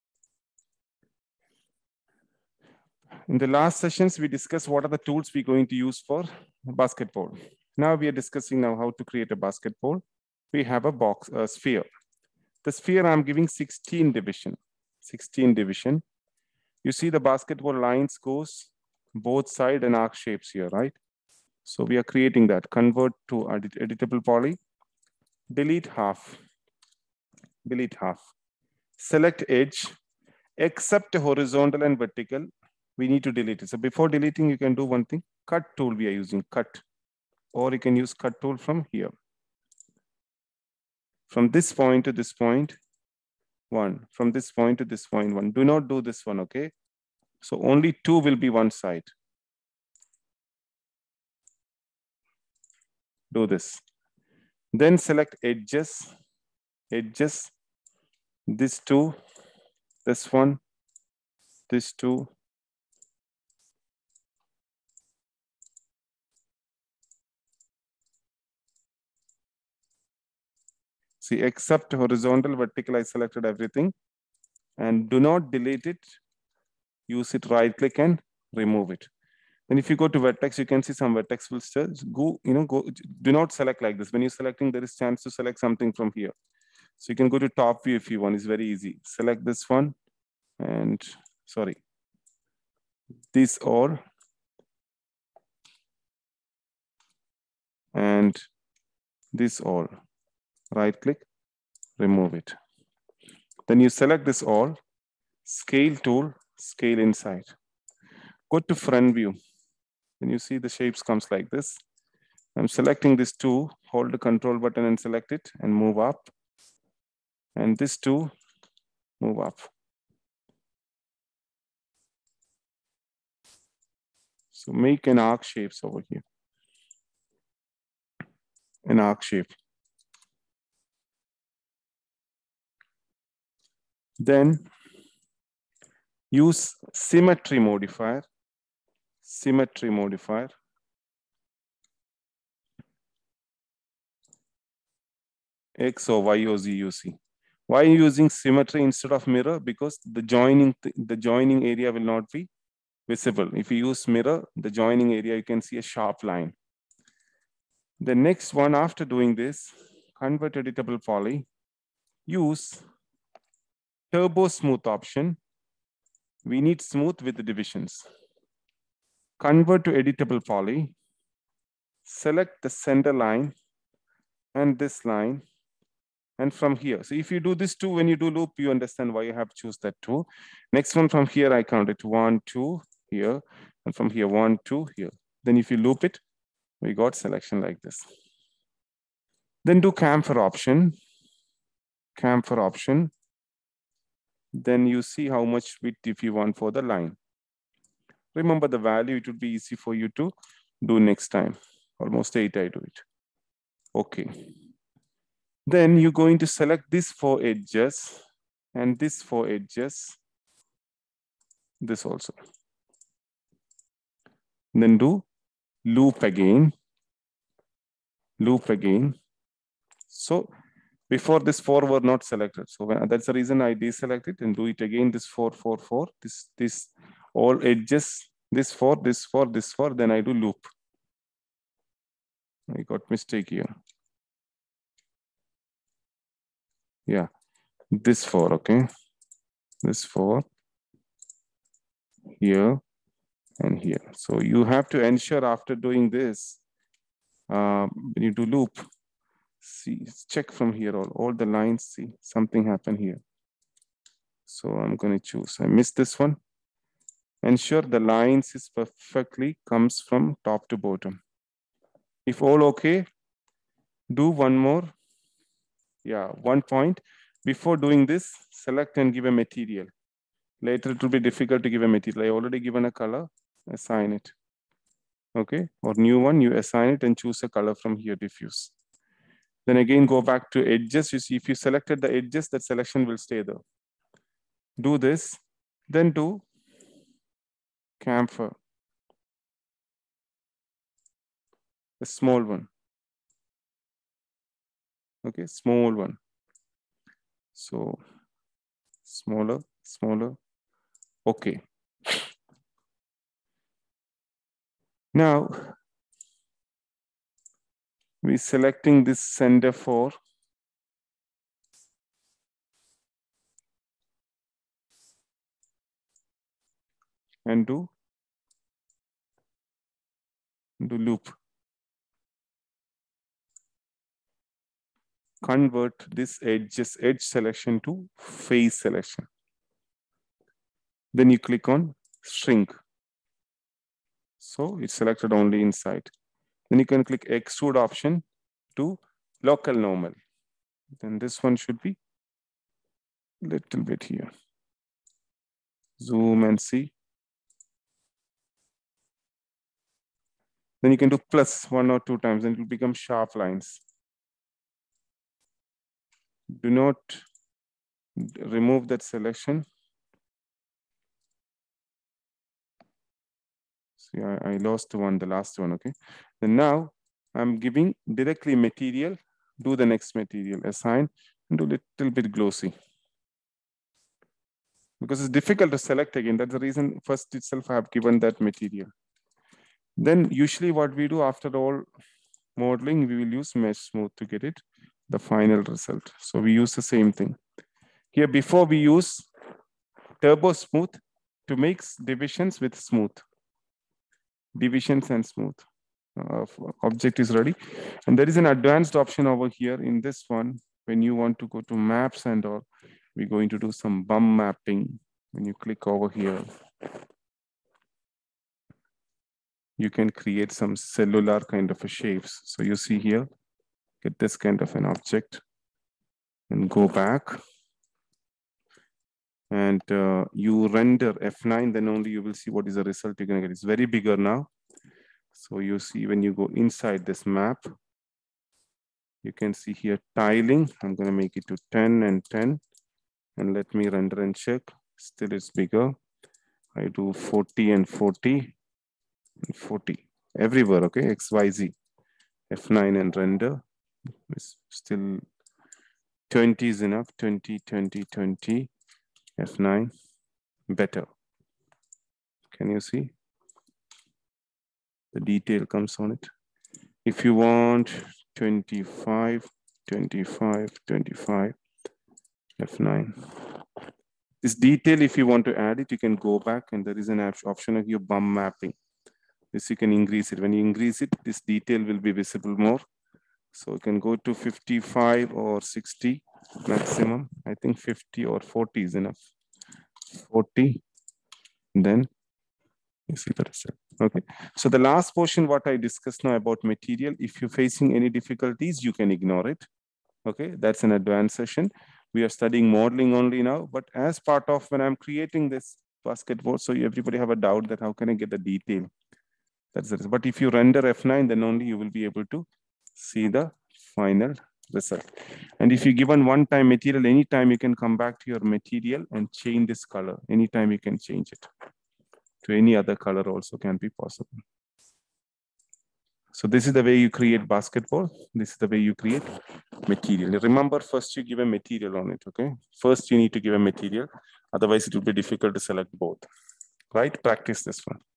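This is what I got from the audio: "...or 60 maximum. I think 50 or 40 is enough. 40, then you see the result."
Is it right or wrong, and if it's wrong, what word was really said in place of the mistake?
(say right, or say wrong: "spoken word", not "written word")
right.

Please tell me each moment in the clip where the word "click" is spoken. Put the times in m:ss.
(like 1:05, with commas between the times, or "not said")
1:17, 1:40, 5:31, 5:37, 6:45.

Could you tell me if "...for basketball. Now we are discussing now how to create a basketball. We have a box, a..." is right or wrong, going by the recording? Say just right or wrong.
right.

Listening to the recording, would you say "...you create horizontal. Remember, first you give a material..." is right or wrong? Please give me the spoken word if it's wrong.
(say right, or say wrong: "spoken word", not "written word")
wrong: "material", not "horizontal".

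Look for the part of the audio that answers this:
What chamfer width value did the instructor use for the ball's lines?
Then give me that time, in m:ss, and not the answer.
3:22.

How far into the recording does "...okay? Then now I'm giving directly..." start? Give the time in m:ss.
6:05.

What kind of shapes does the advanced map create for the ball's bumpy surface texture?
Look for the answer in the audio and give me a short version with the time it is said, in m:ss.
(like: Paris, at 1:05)
Cellular, at 6:50.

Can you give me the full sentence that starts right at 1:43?
Then you select this all, scale tool, scale inside.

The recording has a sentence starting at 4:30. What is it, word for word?
Later it will be difficult to give a material.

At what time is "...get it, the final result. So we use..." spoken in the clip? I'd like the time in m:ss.
6:24.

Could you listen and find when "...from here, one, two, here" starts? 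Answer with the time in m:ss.
3:03.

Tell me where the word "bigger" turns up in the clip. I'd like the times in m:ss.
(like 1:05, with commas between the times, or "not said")
7:03, 7:15.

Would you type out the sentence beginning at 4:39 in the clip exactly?
Then again, go back to edges.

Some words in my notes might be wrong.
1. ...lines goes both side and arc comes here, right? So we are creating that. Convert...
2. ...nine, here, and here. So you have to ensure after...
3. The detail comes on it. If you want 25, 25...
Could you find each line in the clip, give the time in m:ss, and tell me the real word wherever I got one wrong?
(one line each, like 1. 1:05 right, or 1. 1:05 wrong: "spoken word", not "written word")
1. 0:17 wrong: "shapes", not "comes"
2. 4:00 wrong: "four", not "nine"
3. 7:35 right.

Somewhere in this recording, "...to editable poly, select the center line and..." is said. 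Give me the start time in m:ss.
2:49.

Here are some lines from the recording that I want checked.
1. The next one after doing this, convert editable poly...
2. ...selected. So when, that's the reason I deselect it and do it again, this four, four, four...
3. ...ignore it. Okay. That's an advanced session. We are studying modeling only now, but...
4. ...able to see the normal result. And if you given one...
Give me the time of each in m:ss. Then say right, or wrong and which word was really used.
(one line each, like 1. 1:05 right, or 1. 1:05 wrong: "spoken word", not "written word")
1. 2:37 right
2. 3:42 right
3. 8:09 right
4. 8:22 wrong: "final", not "normal".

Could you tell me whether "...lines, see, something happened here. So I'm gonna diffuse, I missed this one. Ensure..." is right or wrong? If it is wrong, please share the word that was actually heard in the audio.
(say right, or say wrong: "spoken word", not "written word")
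wrong: "choose", not "diffuse".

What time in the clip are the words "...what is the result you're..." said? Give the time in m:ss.
7:02.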